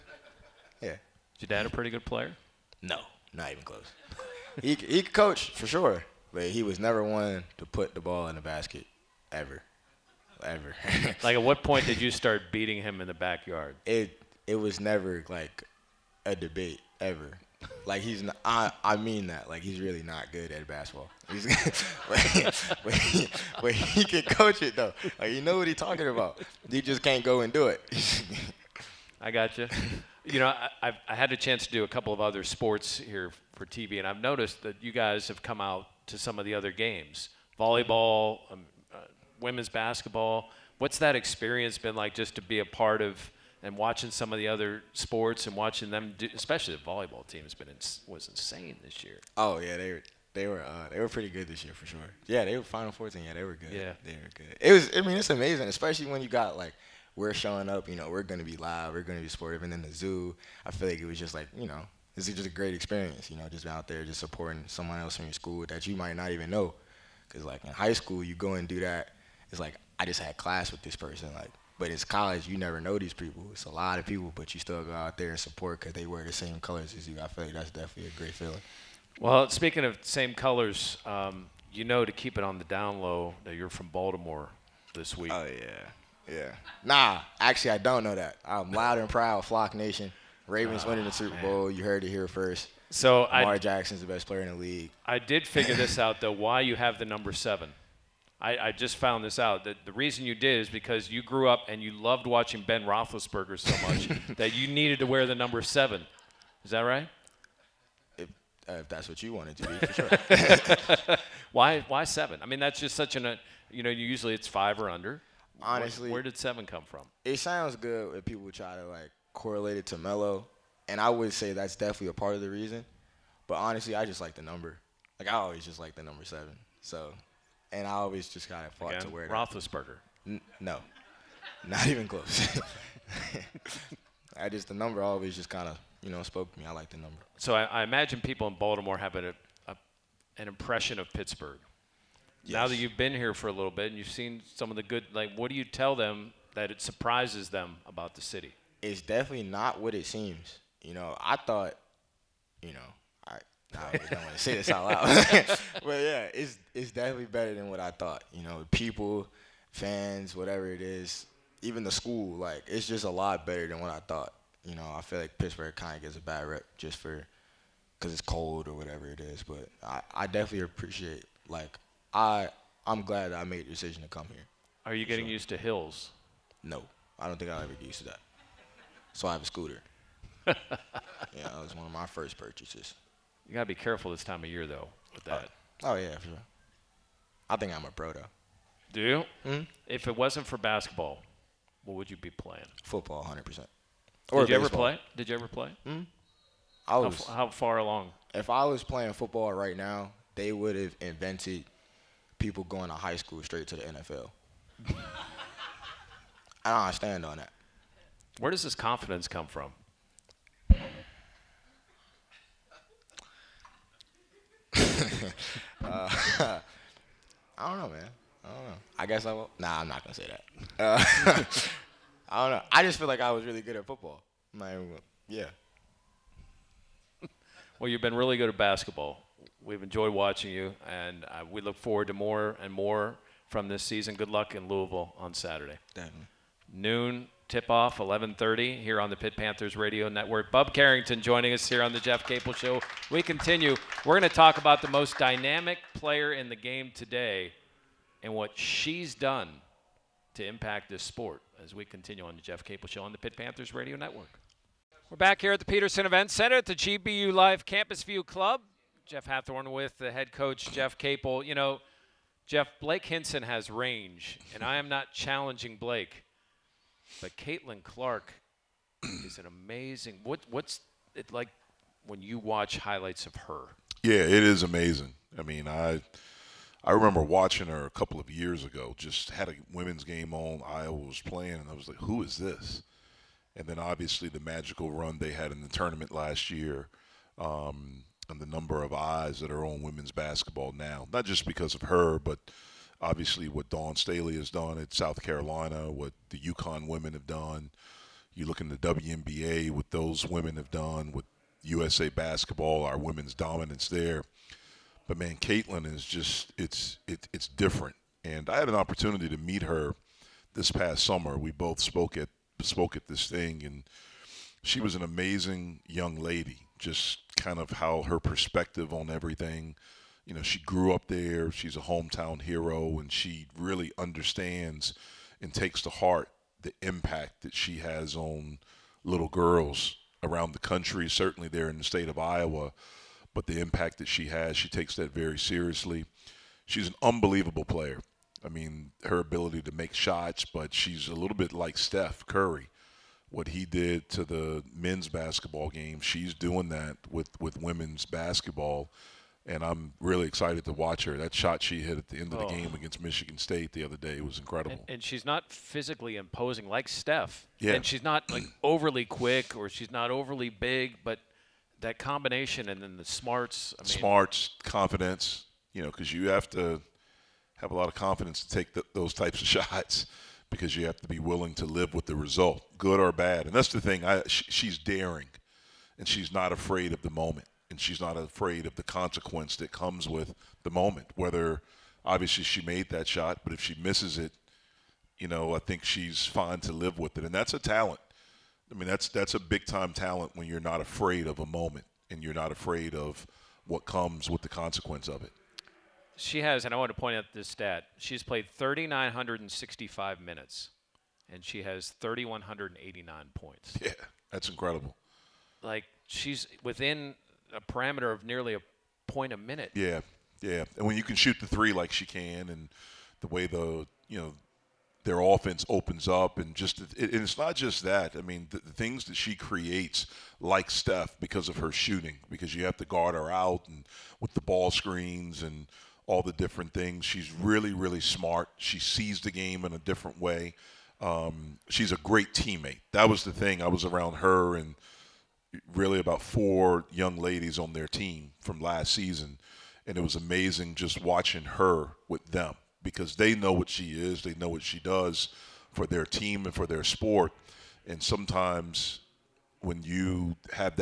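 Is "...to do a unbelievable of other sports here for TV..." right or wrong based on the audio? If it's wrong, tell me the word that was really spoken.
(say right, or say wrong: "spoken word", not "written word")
wrong: "couple", not "unbelievable".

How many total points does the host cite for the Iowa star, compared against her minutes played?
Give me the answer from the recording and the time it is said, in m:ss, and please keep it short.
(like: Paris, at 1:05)
3,189, at 6:42.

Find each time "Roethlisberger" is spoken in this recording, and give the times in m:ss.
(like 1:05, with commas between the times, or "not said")
1:42, 2:09.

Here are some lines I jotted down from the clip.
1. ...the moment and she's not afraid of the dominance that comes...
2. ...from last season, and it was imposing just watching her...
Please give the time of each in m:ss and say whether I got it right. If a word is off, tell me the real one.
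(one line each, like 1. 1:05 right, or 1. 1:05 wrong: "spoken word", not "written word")
1. 6:17 wrong: "consequence", not "dominance"
2. 7:18 wrong: "amazing", not "imposing".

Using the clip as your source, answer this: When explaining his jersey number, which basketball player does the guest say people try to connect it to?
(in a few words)
Melo.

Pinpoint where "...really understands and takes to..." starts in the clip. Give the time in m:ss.
5:23.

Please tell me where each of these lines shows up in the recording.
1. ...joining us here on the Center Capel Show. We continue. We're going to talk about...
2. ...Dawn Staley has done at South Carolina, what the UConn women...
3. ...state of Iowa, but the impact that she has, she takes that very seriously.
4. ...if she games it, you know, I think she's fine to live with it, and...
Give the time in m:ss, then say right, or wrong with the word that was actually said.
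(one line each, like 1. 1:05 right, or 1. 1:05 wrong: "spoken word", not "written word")
1. 4:01 wrong: "Jeff", not "Center"
2. 4:53 right
3. 5:31 right
4. 6:23 wrong: "misses", not "games".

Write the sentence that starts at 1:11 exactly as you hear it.
Like but it's college, you never know these people.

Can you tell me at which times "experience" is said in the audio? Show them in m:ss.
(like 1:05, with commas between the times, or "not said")
0:41, 1:02.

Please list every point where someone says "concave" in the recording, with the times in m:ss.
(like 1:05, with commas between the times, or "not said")
not said.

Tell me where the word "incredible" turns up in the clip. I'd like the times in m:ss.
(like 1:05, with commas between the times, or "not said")
5:54, 6:44.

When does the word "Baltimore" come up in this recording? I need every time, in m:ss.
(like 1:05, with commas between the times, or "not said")
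1:23, 2:18.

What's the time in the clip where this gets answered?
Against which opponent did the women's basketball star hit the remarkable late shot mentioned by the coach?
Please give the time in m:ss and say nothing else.
5:53.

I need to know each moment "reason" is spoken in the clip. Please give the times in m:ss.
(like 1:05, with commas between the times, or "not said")
1:39, 2:02.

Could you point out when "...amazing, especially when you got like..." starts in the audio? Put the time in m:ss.
0:55.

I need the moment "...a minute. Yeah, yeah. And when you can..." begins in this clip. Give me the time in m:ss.
6:49.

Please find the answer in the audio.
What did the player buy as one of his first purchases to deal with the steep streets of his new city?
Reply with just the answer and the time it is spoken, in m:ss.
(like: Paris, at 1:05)
A scooter, at 2:59.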